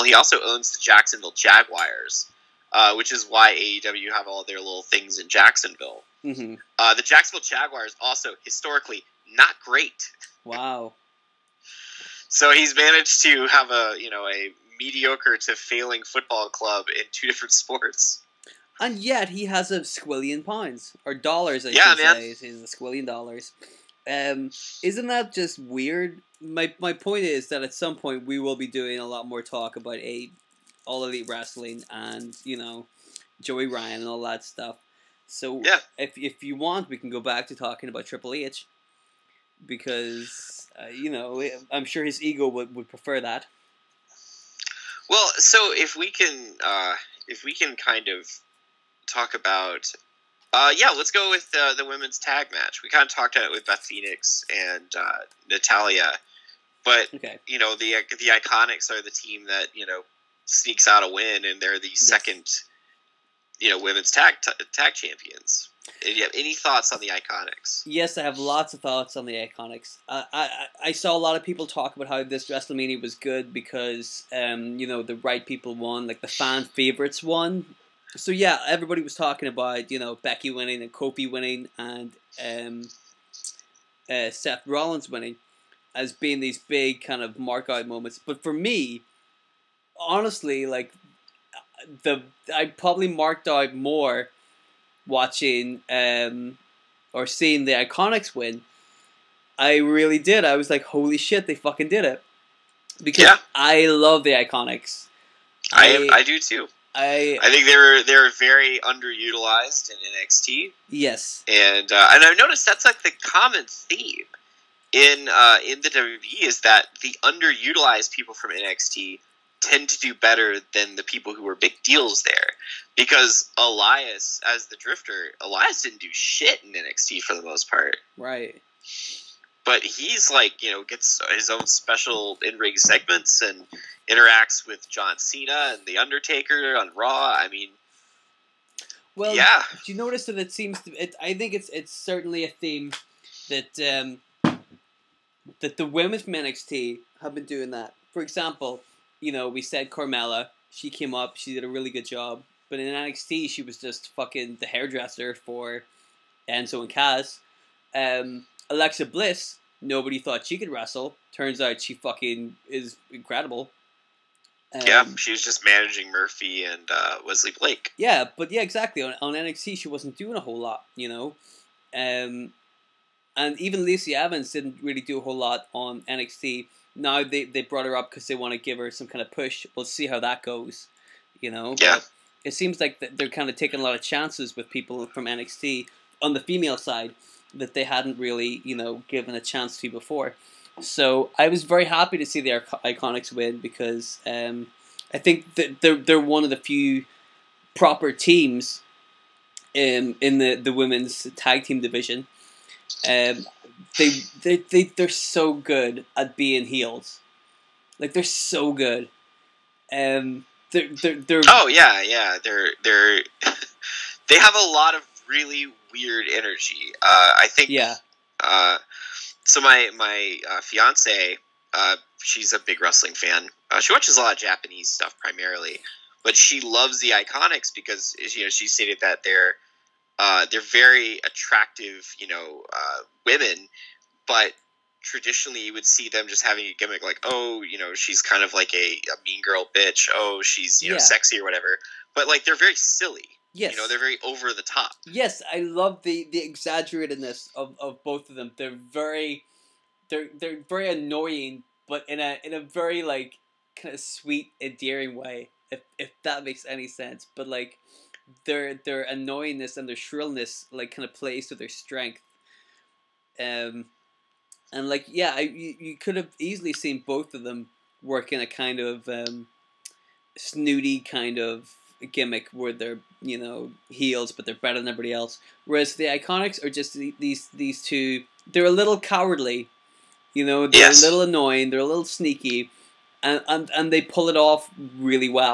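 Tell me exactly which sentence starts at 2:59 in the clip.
We'll see how that goes, you know.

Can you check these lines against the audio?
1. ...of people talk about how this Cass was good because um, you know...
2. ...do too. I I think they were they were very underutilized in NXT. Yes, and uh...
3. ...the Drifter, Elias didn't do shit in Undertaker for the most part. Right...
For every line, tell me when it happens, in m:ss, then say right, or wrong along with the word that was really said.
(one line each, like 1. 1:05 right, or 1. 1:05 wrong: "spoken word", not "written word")
1. 1:11 wrong: "WrestleMania", not "Cass"
2. 1:46 right
3. 2:04 wrong: "NXT", not "Undertaker".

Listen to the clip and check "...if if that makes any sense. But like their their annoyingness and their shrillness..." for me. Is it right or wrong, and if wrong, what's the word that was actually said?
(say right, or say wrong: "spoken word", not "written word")
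right.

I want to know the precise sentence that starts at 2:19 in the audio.
Do you notice that it seems?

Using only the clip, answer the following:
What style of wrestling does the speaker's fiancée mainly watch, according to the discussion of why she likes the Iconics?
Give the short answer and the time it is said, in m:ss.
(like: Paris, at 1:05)
Japanese, at 3:44.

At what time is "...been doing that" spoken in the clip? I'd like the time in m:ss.
2:27.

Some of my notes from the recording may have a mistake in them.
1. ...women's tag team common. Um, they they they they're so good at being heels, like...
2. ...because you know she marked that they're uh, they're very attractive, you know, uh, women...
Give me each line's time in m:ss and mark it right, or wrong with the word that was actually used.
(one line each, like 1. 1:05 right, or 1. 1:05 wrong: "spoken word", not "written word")
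1. 3:20 wrong: "division", not "common"
2. 3:47 wrong: "stated", not "marked".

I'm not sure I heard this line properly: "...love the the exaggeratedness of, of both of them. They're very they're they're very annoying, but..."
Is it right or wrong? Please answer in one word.
right.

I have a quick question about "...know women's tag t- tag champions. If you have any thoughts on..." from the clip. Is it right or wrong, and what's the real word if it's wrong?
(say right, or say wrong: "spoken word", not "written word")
right.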